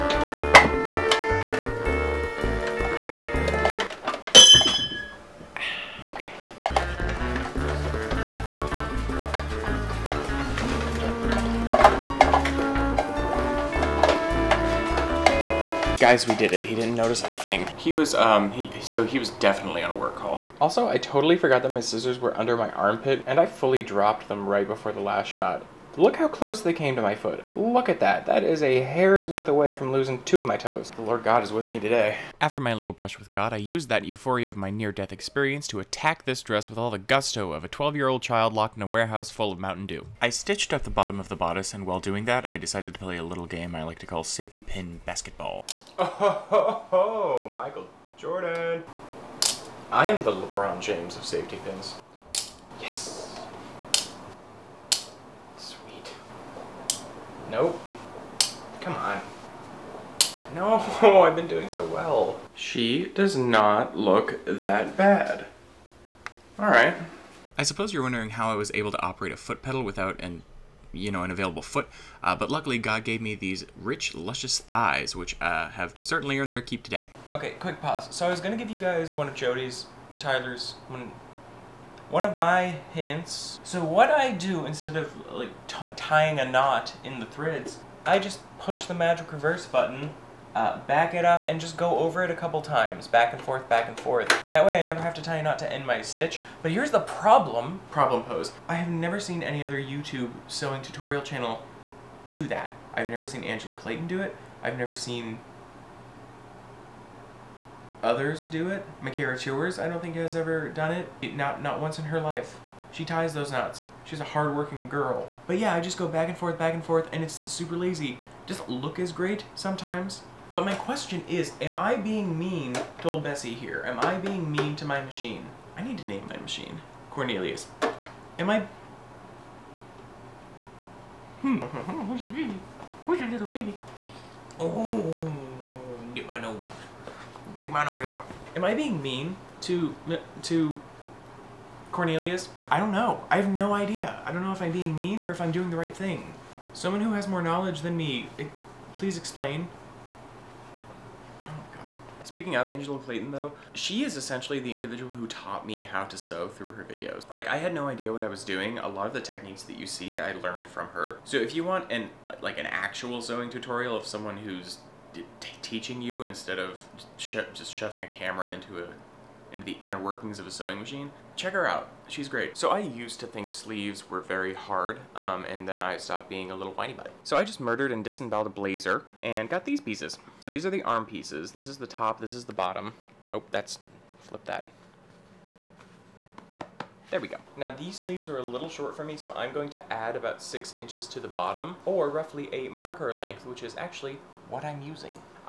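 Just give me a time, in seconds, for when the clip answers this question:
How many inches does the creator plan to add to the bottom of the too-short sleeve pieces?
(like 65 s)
190 s.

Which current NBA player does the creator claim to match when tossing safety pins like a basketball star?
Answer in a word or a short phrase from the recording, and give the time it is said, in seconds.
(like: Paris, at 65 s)
LeBron James, at 50 s.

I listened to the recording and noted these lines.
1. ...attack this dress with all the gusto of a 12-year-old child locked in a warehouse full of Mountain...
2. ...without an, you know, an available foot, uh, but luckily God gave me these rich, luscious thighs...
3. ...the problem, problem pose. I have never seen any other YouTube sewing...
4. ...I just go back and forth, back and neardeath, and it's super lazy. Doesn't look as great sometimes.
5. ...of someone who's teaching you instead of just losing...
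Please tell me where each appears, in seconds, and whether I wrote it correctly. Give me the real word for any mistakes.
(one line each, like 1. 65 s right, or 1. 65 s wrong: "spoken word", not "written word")
1. 35 s right
2. 69 s right
3. 96 s right
4. 115 s wrong: "forth", not "neardeath"
5. 163 s wrong: "shoving", not "losing".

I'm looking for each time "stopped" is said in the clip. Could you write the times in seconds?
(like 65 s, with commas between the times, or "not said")
175 s.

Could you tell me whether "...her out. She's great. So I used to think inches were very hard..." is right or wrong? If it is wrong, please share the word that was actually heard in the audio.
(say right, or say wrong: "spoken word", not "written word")
wrong: "sleeves", not "inches".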